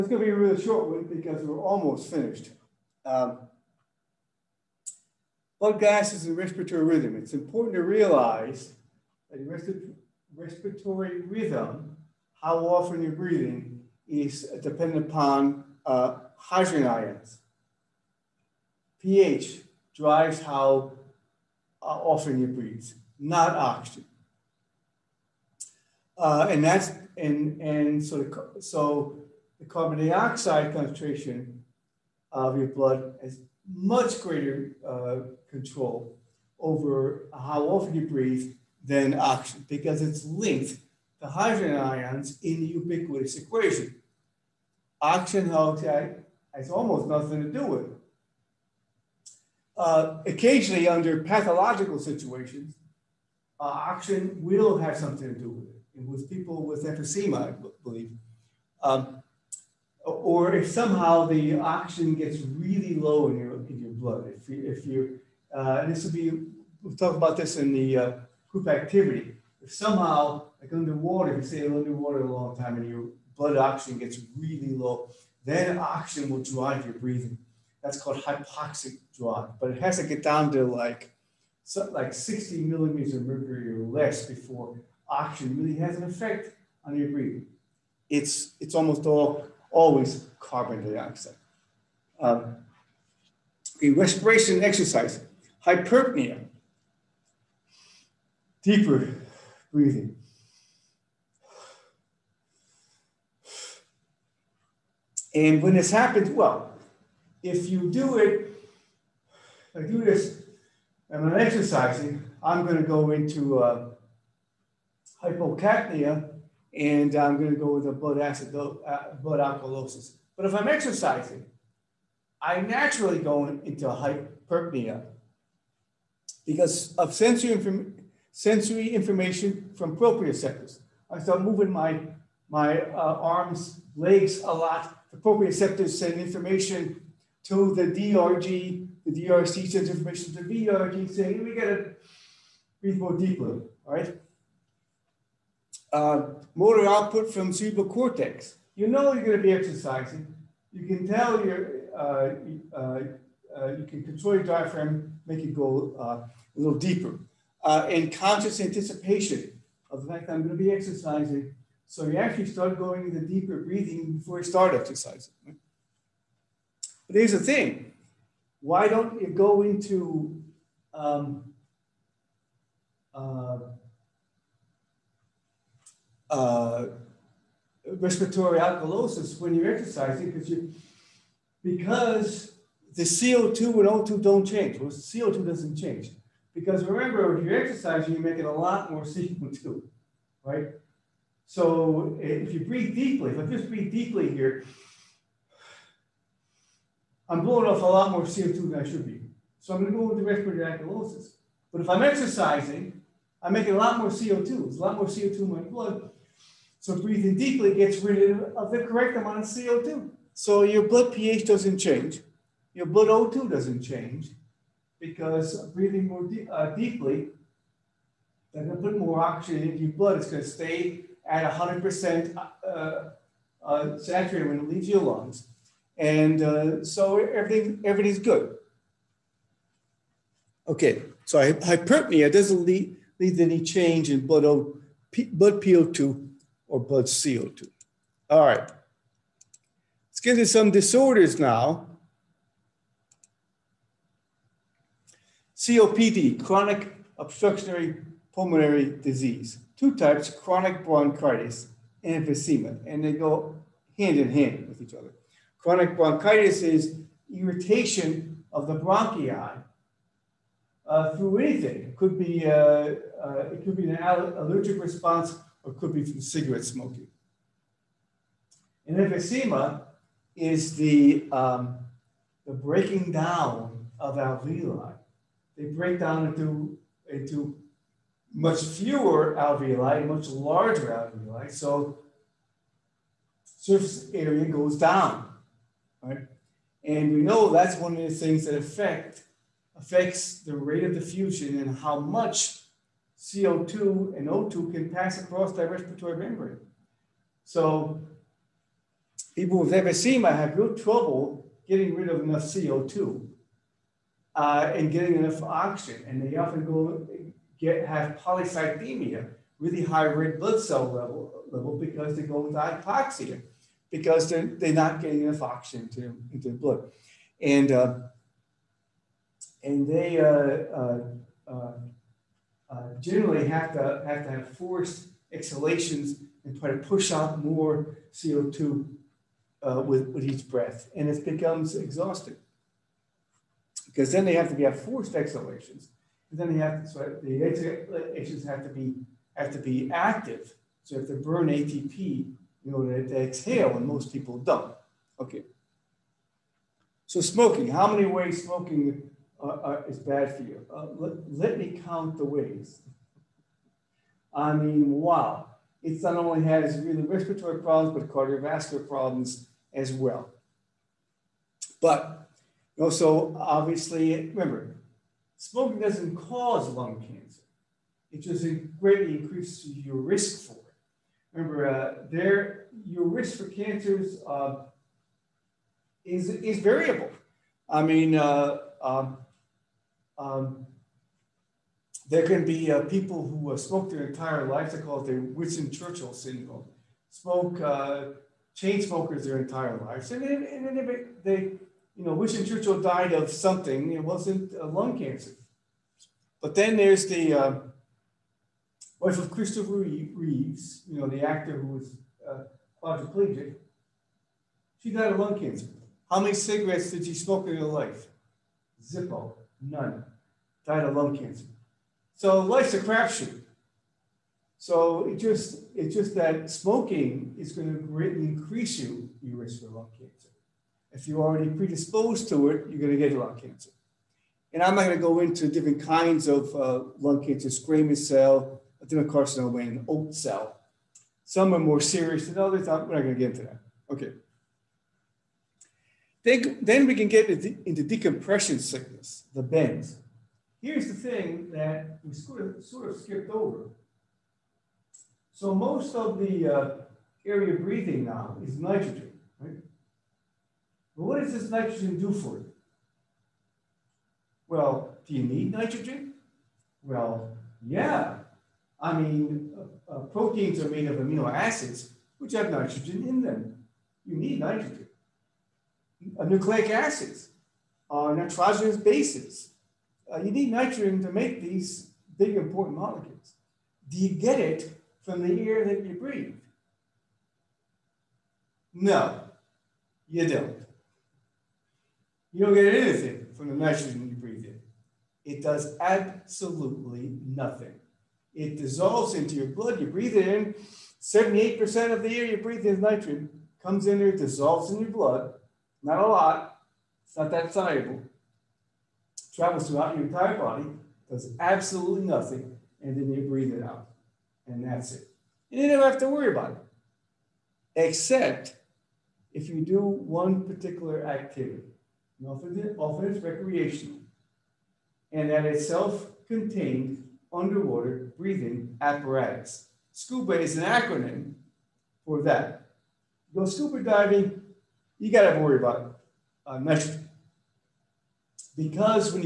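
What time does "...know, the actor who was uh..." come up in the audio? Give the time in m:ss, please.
6:40.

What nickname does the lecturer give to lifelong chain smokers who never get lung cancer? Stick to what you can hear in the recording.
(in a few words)
Winston Churchill syndrome.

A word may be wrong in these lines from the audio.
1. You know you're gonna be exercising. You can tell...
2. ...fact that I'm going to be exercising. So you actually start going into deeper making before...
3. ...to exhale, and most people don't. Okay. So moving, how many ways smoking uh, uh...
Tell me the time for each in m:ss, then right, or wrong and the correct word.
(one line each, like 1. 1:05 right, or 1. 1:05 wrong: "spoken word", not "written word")
1. 2:28 right
2. 2:40 wrong: "breathing", not "making"
3. 5:43 wrong: "smoking", not "moving".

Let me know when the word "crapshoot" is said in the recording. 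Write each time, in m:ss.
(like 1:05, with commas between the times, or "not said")
6:52.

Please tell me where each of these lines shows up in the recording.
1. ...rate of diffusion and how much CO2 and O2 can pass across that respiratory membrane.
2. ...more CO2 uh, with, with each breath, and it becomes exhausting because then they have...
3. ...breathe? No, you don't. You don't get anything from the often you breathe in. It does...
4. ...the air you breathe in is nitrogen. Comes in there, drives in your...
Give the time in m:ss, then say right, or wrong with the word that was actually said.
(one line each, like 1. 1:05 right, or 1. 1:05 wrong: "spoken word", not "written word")
1. 4:50 right
2. 5:27 right
3. 7:55 wrong: "nitrogen", not "often"
4. 8:12 wrong: "dissolves", not "drives".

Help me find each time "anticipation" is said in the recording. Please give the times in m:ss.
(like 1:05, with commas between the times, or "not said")
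2:38.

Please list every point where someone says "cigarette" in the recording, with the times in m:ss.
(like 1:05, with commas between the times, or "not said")
4:26, 6:46.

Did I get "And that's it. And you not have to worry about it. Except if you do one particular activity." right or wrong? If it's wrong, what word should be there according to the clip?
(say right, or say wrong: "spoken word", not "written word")
right.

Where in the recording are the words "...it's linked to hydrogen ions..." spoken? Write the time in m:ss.
0:40.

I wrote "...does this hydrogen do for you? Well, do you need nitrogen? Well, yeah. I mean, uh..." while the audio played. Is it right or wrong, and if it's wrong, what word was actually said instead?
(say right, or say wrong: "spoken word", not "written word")
wrong: "nitrogen", not "hydrogen".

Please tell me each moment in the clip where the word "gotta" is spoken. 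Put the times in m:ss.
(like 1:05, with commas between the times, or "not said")
2:21, 8:45.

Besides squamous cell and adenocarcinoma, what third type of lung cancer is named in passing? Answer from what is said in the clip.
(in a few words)
oat cell.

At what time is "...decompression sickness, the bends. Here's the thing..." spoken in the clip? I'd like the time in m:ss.
7:17.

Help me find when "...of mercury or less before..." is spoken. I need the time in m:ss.
1:23.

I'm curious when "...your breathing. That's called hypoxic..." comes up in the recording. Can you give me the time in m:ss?
1:16.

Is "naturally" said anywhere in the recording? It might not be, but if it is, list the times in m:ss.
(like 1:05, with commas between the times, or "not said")
2:02.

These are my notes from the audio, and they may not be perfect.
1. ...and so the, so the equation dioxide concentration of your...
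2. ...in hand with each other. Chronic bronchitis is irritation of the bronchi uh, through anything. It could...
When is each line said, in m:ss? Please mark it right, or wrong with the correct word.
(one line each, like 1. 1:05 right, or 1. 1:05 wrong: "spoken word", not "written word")
1. 0:27 wrong: "carbon", not "equation"
2. 4:14 right.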